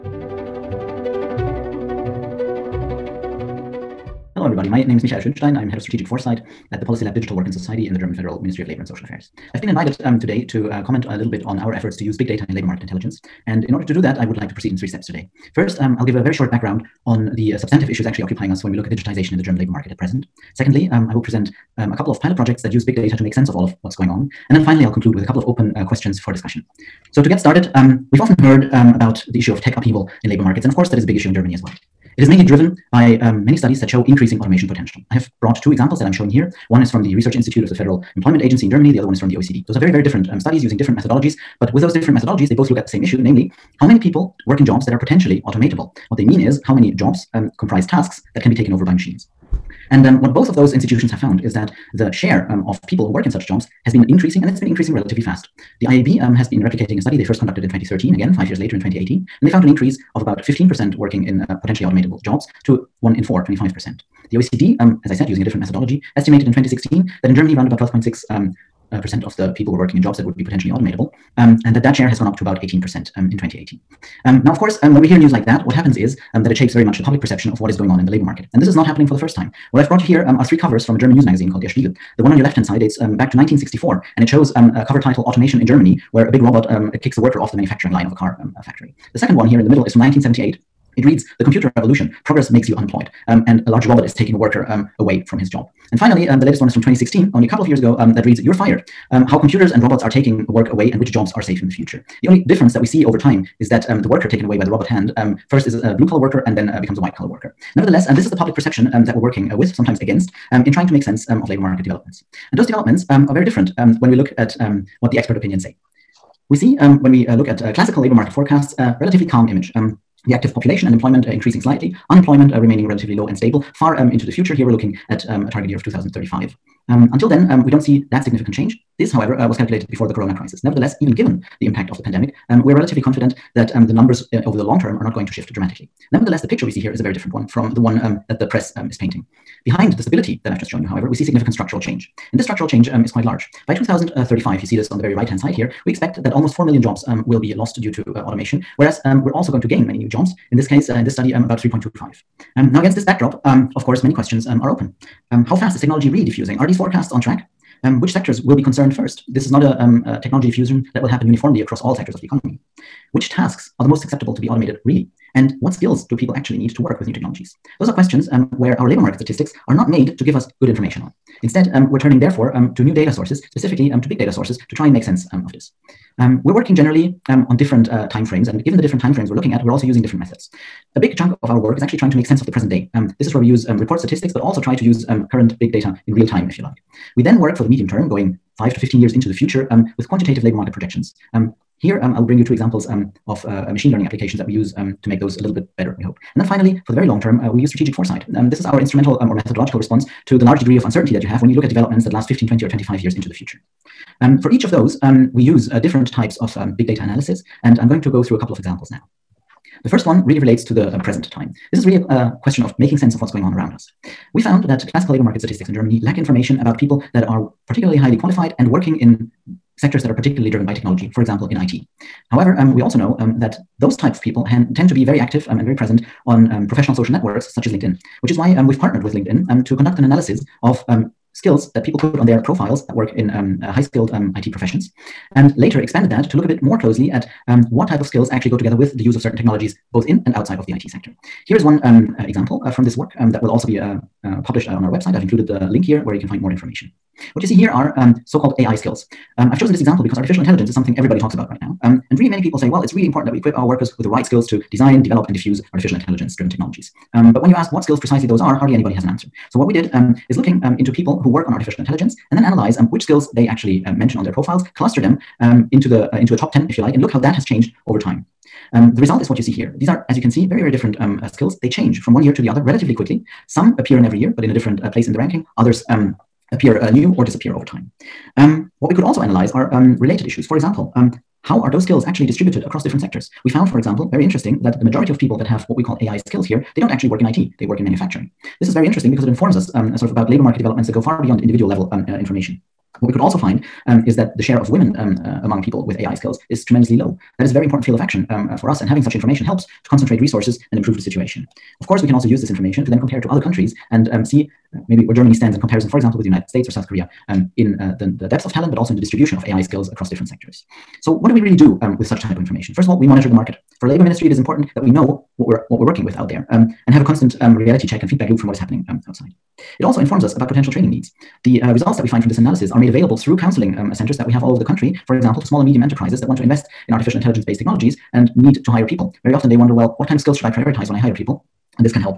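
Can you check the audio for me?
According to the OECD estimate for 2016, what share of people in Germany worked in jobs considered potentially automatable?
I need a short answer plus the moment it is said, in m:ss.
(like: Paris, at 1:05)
12.6%, at 1:07.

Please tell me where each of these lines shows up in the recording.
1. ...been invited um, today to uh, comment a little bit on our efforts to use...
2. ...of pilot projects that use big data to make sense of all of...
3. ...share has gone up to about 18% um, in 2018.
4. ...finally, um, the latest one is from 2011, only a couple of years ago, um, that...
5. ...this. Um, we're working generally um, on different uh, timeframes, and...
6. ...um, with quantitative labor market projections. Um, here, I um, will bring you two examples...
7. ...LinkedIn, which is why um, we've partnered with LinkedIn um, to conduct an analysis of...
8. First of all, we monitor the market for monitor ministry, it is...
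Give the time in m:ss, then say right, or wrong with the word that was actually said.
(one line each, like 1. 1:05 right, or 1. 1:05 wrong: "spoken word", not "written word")
1. 0:09 right
2. 0:22 right
3. 1:11 right
4. 1:35 wrong: "2016", not "2011"
5. 2:55 right
6. 3:09 right
7. 3:47 right
8. 5:12 wrong: "labor", not "monitor".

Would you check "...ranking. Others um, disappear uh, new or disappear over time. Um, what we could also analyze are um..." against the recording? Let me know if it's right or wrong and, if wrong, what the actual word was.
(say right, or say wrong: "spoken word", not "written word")
wrong: "appear", not "disappear".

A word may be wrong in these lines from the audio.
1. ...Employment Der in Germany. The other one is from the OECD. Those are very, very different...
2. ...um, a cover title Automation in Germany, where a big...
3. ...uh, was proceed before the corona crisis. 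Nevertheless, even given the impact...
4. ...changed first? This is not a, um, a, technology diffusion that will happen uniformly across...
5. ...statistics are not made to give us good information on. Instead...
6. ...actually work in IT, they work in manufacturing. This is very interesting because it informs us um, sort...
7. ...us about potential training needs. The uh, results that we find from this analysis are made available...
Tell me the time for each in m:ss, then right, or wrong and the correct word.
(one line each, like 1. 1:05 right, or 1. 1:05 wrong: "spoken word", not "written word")
1. 0:38 wrong: "Agency", not "Der"
2. 1:24 right
3. 2:09 wrong: "calculated", not "proceed"
4. 2:38 wrong: "concerned", not "changed"
5. 2:49 right
6. 4:46 right
7. 5:20 right.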